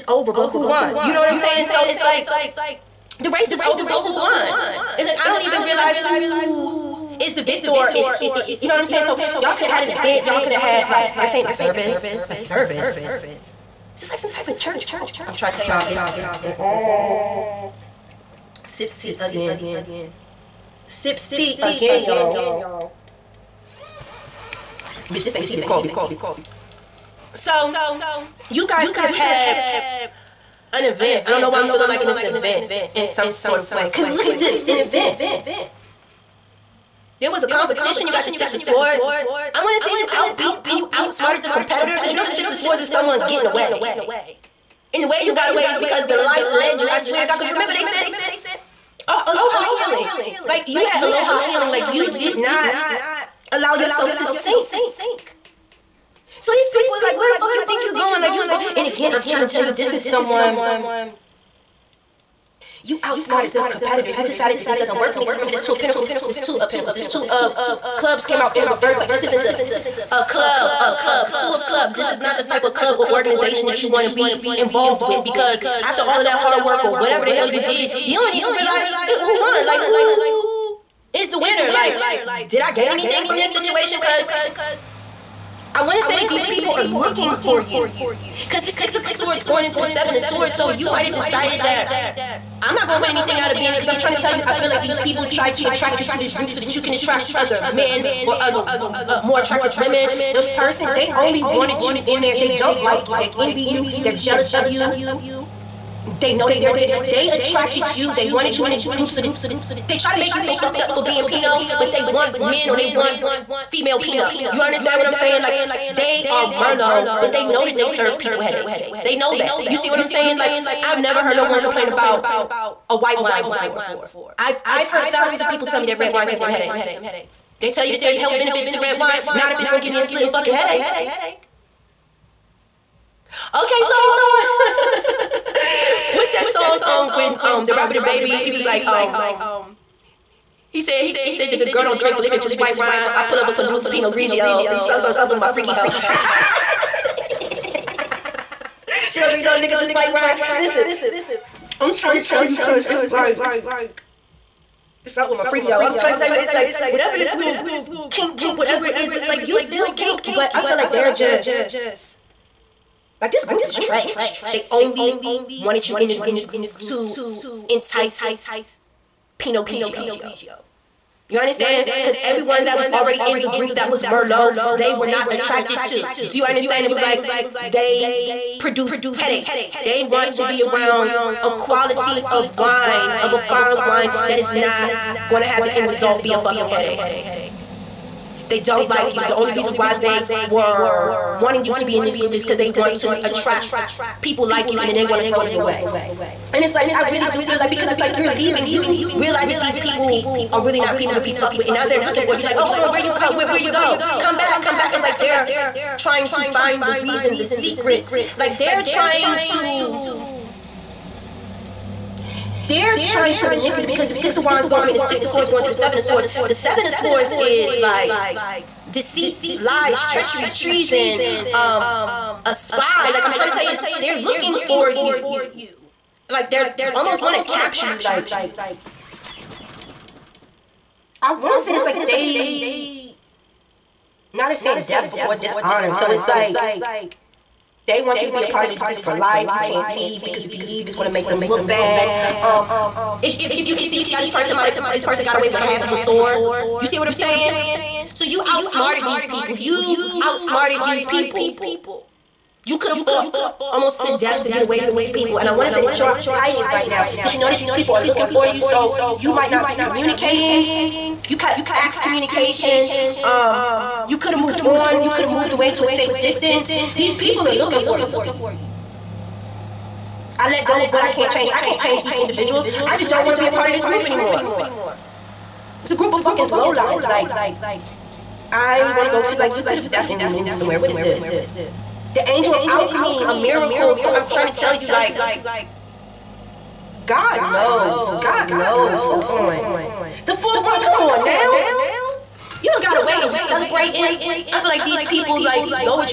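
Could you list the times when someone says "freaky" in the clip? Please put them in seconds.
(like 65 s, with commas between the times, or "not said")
145 s, 155 s.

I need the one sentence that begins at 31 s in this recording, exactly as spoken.
I don't know why I'm feeling like in this event in some sort of way.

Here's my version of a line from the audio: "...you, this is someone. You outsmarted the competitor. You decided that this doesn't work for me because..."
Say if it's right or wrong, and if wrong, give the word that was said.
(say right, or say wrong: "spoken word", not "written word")
right.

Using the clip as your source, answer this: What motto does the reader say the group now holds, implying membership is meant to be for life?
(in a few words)
Death before dishonor.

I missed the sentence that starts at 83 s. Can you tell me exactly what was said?
Because I want to say that these people are looking for you.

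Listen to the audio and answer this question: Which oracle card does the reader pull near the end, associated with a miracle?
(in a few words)
The angel of alchemy.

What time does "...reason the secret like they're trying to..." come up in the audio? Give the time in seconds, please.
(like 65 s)
207 s.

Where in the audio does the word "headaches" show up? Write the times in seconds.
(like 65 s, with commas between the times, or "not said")
118 s, 126 s, 130 s, 179 s, 186 s.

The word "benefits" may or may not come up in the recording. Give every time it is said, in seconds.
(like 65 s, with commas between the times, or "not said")
128 s.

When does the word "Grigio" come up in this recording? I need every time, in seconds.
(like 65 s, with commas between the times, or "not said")
144 s, 169 s.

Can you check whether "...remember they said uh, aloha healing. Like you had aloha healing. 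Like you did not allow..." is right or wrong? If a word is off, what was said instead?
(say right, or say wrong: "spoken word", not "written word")
right.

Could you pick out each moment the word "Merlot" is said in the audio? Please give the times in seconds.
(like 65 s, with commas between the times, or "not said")
116 s, 174 s.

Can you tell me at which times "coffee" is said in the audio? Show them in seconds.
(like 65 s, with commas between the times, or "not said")
25 s.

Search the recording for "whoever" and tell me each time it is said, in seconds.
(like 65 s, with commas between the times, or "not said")
not said.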